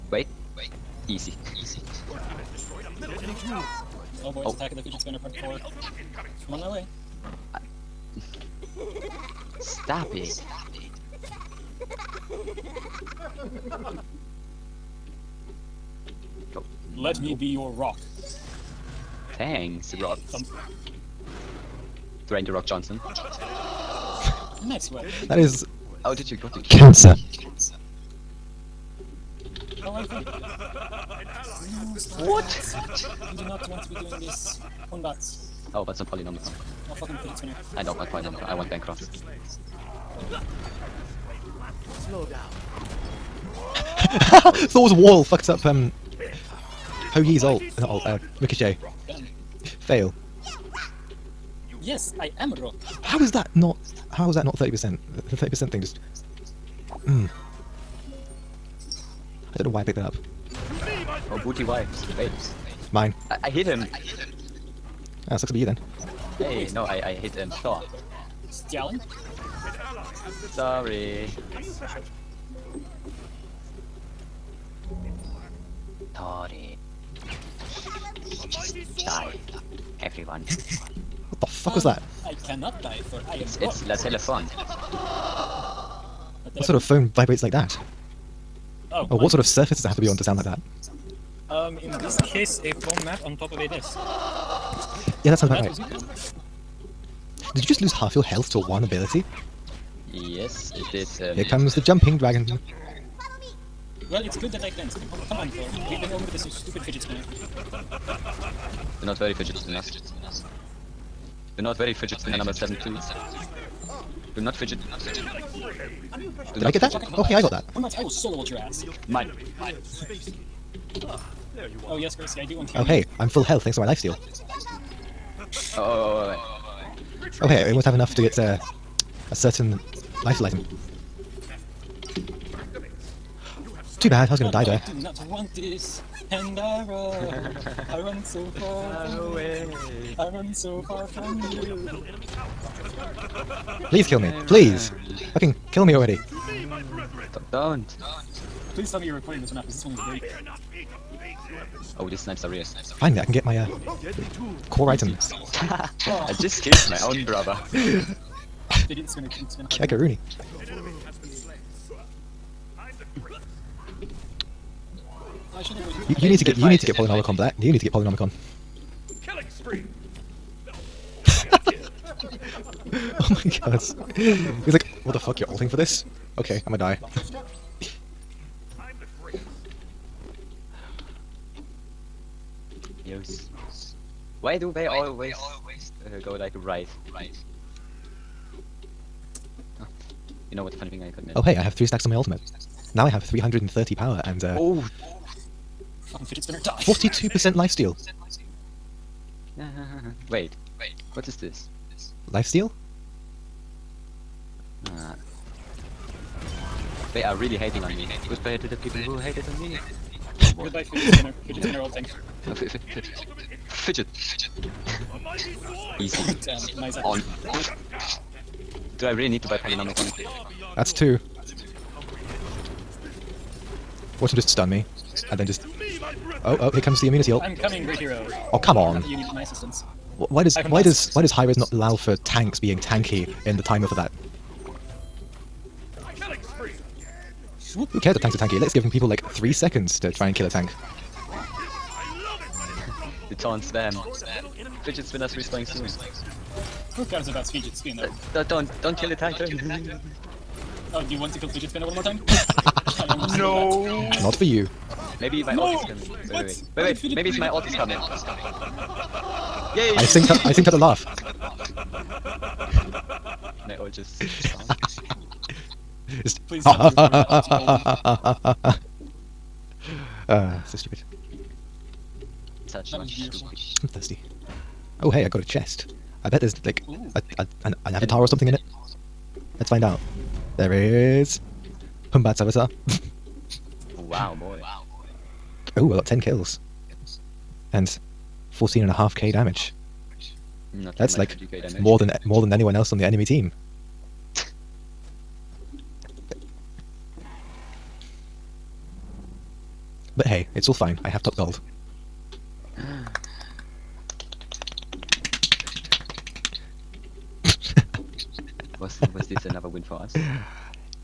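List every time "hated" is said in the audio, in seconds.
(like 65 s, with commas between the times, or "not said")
209 s.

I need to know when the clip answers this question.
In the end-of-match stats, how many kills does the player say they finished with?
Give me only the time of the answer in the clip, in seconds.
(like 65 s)
286 s.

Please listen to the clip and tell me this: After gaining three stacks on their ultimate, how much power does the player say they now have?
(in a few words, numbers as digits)
330.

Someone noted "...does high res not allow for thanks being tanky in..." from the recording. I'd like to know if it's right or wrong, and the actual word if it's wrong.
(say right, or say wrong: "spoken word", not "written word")
wrong: "tanks", not "thanks".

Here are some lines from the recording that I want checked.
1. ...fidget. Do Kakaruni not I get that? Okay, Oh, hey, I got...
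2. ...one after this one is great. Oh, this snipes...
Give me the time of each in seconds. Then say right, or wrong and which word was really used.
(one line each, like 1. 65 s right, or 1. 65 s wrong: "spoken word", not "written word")
1. 114 s wrong: "Did", not "Kakaruni"
2. 149 s right.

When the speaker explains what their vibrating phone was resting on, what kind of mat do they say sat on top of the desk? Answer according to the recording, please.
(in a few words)
foam mat.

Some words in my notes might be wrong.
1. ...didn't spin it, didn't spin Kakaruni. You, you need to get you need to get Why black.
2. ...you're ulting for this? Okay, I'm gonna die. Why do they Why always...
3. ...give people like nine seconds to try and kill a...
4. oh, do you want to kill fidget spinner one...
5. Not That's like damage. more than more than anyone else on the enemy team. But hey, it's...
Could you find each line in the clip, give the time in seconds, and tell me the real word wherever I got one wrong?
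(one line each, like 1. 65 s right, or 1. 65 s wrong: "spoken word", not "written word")
1. 158 s wrong: "Polynomicon", not "Why"
2. 175 s right
3. 238 s wrong: "three", not "nine"
4. 250 s right
5. 290 s right.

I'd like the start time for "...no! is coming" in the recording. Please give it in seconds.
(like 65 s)
255 s.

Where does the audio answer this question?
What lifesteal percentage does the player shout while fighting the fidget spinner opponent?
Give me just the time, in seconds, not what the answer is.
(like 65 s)
196 s.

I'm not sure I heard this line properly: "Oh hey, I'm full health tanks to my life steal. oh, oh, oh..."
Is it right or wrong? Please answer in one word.
wrong.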